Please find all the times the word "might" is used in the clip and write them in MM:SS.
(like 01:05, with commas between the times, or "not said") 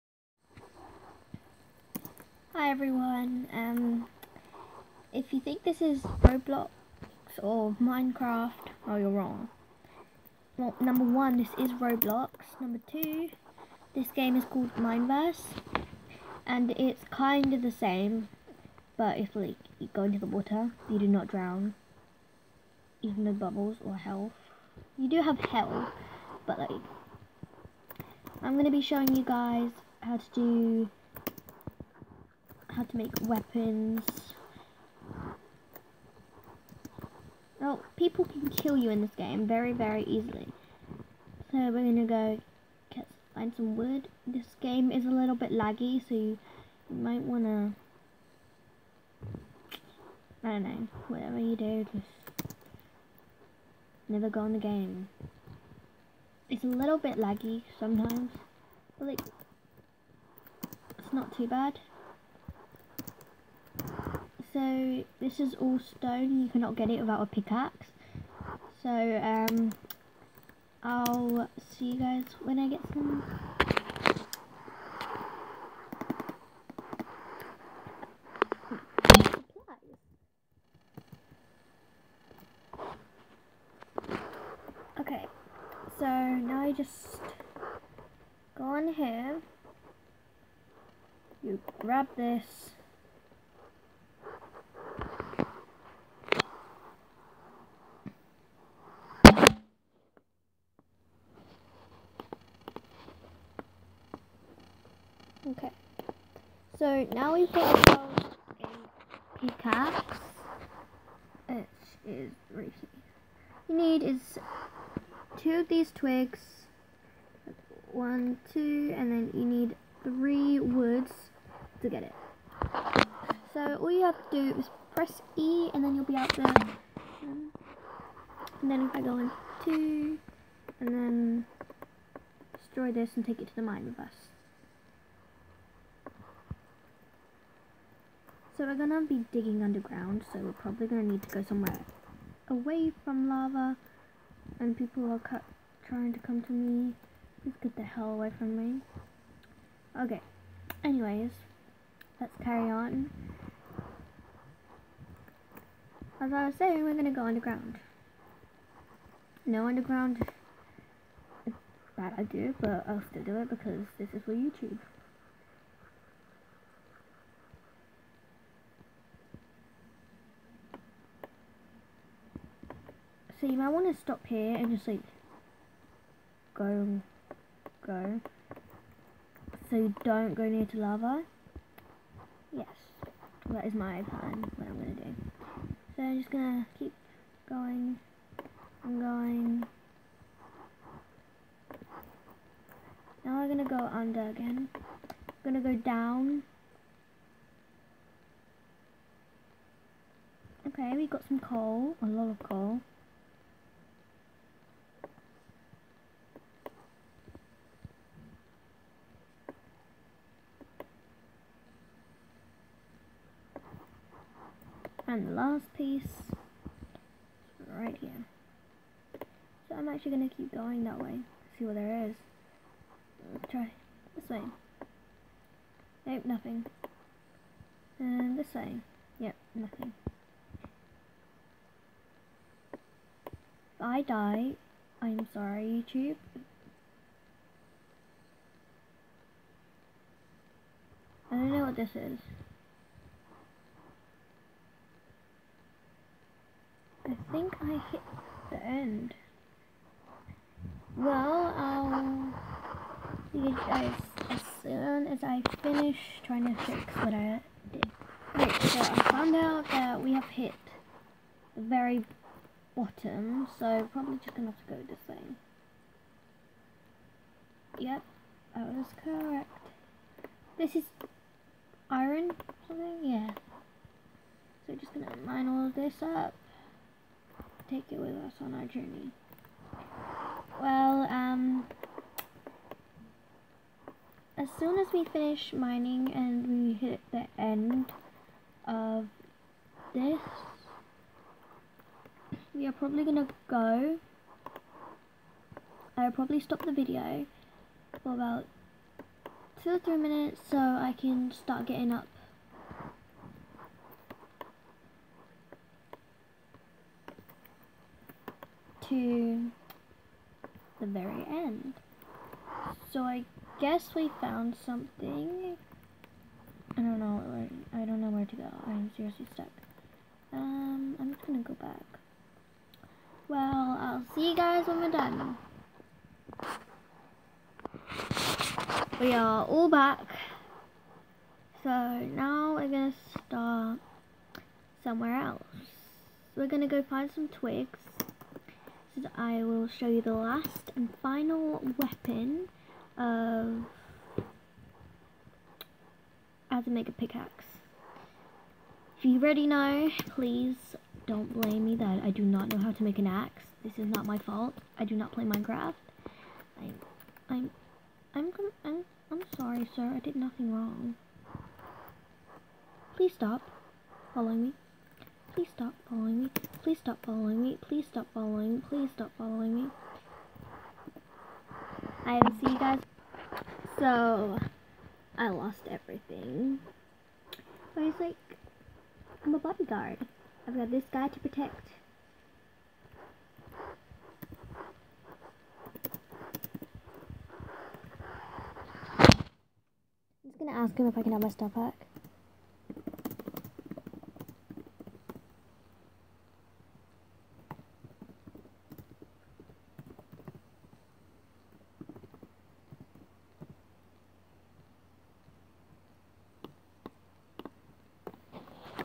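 00:46, 02:53.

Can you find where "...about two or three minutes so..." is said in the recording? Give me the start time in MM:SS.
04:58.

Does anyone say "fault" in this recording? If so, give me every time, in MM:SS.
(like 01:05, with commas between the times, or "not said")
05:54.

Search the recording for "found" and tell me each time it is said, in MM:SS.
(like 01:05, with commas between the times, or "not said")
04:19, 05:14.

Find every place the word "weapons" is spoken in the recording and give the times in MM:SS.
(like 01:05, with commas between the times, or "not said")
00:33, 05:41.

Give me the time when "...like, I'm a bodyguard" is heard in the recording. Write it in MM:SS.
06:18.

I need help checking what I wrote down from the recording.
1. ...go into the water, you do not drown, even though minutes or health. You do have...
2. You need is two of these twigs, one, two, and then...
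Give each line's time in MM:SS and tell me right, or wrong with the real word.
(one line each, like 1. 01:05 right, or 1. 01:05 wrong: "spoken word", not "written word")
1. 00:19 wrong: "bubbles", not "minutes"
2. 01:53 right.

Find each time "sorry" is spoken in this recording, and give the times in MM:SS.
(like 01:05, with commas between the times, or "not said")
03:55, 05:59.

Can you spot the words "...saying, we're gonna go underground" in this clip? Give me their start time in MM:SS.
02:36.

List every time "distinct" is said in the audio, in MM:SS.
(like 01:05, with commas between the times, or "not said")
not said.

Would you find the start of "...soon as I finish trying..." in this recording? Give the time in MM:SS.
04:14.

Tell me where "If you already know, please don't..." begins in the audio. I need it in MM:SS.
05:48.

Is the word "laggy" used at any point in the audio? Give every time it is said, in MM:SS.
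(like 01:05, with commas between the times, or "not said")
00:45, 00:57.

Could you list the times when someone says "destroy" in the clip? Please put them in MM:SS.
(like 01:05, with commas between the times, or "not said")
02:12.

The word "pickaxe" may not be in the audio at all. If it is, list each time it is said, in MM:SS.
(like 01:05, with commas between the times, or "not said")
01:07, 01:49, 05:46.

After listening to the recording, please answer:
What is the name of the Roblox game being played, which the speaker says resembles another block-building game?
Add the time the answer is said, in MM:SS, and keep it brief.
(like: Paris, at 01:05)
Mineverse, at 00:14.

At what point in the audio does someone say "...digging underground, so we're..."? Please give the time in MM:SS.
02:19.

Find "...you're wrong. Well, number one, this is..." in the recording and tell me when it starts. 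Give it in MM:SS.
00:08.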